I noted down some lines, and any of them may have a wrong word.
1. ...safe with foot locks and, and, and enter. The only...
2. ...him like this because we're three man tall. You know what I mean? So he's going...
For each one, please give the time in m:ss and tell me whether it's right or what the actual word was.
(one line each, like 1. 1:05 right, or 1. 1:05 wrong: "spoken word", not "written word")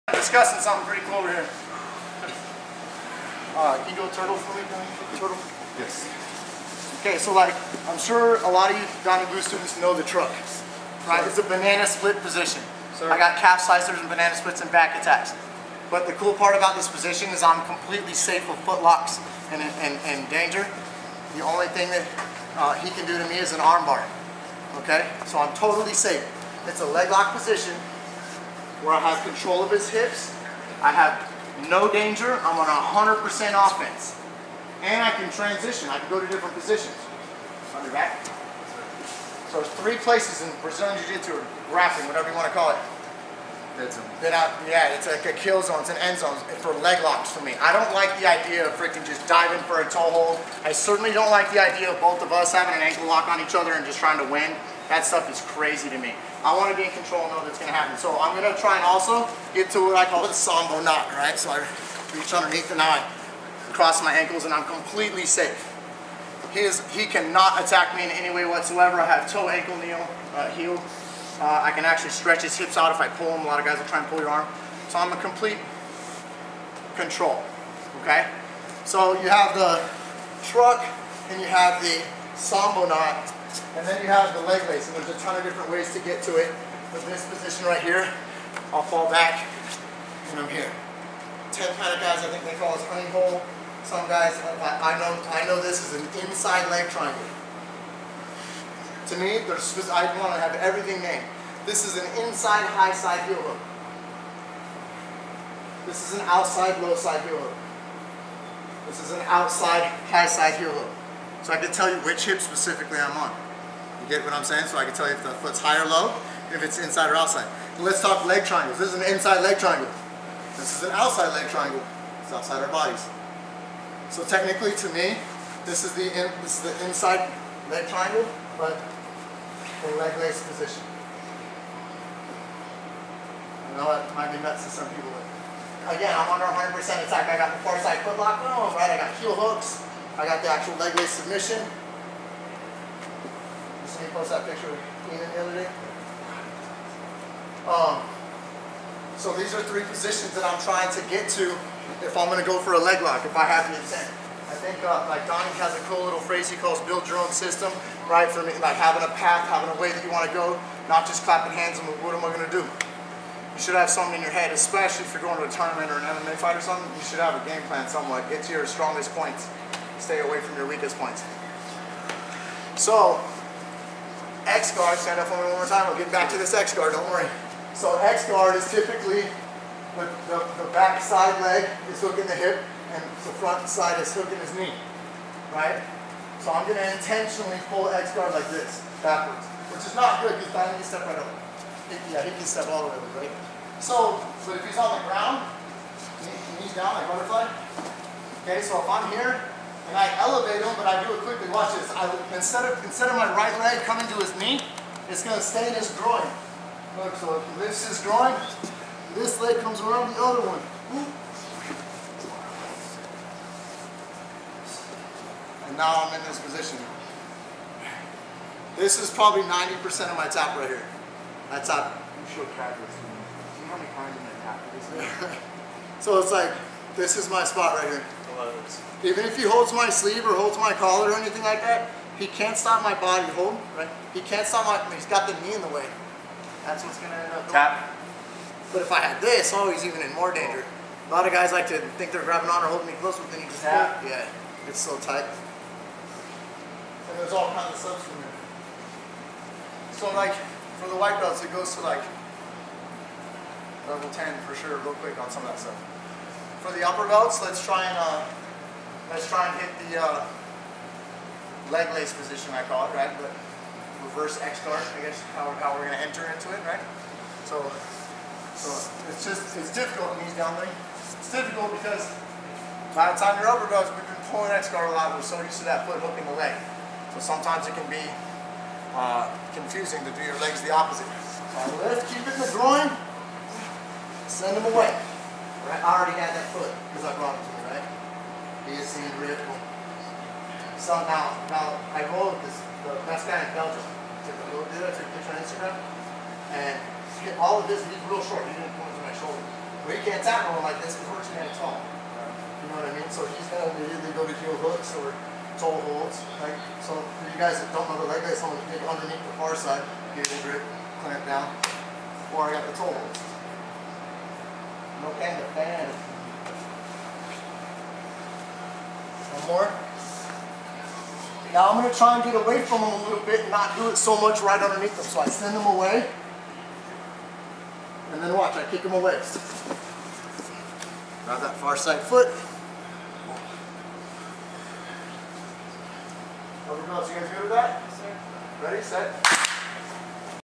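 1. 0:18 wrong: "danger", not "enter"
2. 5:00 wrong: "two", not "three".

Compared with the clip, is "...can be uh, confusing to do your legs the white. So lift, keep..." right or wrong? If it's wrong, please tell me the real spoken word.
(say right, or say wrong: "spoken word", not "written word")
wrong: "opposite", not "white".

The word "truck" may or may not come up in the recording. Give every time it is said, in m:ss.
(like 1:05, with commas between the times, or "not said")
0:10, 1:20.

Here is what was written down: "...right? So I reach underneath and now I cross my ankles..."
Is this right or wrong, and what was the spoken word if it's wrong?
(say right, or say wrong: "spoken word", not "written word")
right.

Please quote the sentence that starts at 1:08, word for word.
I have toe, ankle, knee, uh, heel.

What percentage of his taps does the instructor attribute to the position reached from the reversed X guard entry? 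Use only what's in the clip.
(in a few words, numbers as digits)
90%.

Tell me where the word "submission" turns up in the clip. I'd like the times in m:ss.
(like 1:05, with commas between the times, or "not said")
2:21.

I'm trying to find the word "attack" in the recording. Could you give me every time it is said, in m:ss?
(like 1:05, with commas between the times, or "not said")
0:15, 1:07, 2:16.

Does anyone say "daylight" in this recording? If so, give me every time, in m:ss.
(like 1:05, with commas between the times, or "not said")
not said.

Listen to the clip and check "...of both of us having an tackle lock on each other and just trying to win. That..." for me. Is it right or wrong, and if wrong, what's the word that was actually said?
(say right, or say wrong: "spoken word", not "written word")
wrong: "ankle", not "tackle".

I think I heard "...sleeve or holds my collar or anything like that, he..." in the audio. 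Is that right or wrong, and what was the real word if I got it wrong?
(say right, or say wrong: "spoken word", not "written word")
right.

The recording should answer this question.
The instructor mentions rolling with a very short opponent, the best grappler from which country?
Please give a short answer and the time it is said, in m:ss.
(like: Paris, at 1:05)
Belgium, at 4:53.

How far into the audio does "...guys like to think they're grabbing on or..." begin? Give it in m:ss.
4:01.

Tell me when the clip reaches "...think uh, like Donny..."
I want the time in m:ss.
2:34.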